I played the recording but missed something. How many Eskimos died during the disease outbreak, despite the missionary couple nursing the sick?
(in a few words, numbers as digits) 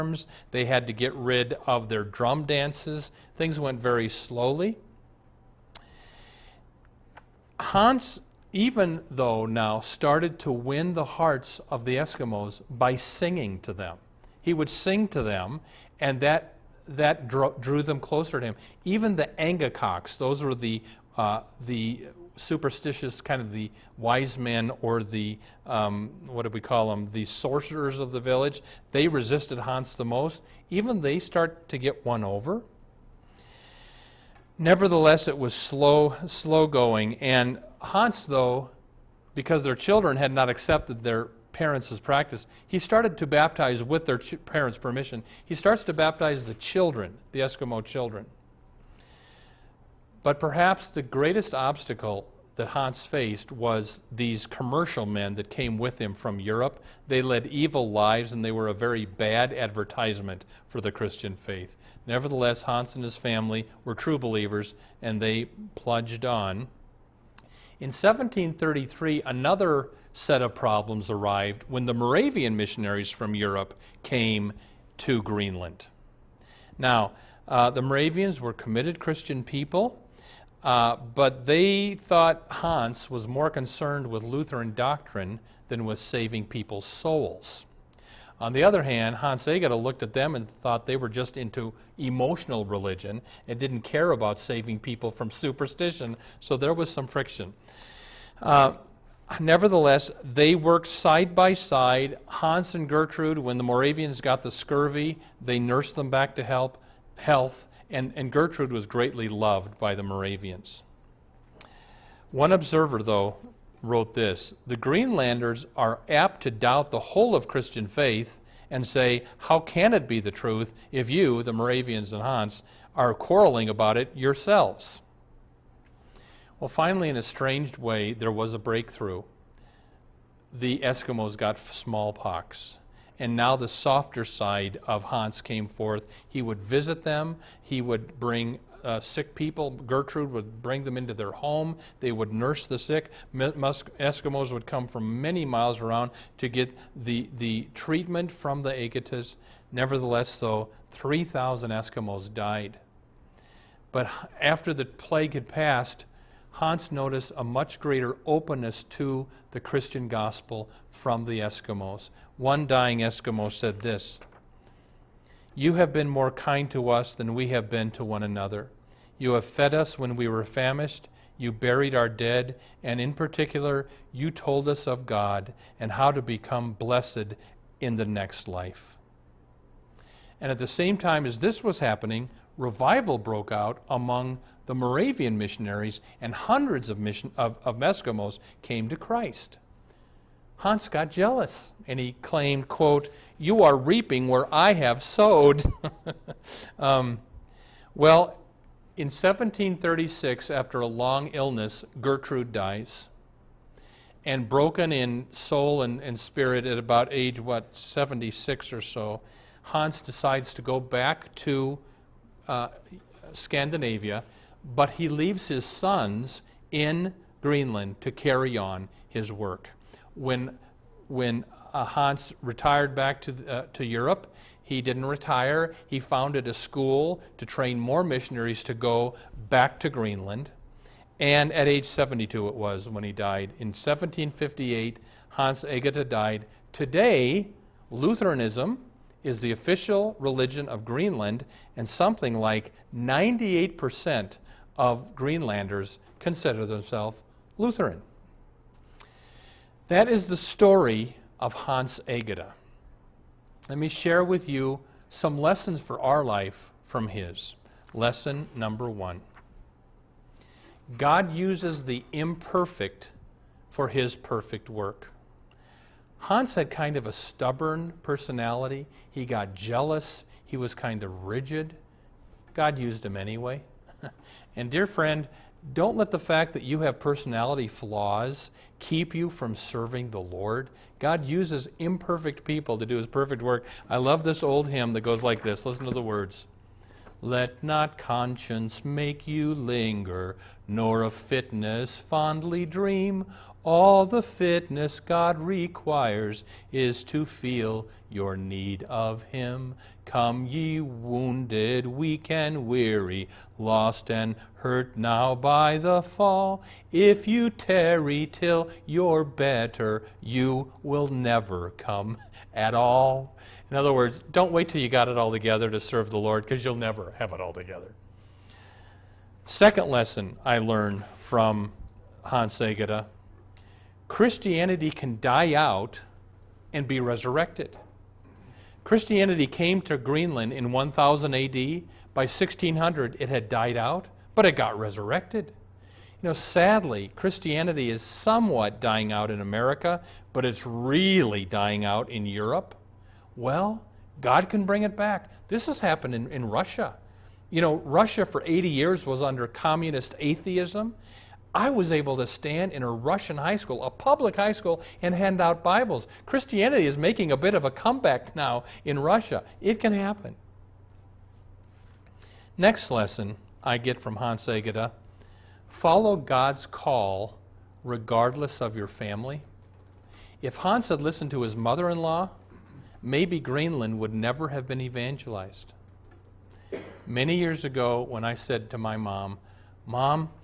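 3,000.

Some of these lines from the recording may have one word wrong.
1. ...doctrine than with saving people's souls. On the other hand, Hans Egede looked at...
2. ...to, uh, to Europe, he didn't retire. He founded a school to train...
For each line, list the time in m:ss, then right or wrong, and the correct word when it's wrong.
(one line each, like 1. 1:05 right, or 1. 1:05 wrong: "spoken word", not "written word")
1. 1:24 right
2. 3:43 right.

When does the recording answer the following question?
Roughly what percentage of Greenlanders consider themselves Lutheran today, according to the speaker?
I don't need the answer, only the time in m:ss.
4:02.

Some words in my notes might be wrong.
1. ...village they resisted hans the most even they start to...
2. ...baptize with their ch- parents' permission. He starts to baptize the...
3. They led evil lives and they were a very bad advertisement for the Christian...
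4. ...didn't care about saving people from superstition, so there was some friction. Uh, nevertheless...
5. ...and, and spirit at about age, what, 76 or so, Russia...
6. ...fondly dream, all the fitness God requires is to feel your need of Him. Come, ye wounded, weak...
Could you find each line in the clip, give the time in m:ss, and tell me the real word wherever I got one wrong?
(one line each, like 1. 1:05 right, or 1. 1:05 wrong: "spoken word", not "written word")
1. 0:28 right
2. 0:43 right
3. 0:57 right
4. 1:33 right
5. 3:25 wrong: "Hans", not "Russia"
6. 4:51 right.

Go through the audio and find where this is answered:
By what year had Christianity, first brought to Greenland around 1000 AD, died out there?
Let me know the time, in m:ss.
5:32.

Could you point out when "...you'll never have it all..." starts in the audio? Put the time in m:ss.
5:16.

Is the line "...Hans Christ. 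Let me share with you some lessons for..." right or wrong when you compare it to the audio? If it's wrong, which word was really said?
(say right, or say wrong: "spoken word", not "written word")
wrong: "Egede", not "Christ".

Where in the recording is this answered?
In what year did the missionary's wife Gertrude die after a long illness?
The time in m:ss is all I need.
3:19.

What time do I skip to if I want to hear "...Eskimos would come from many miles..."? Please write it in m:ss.
2:23.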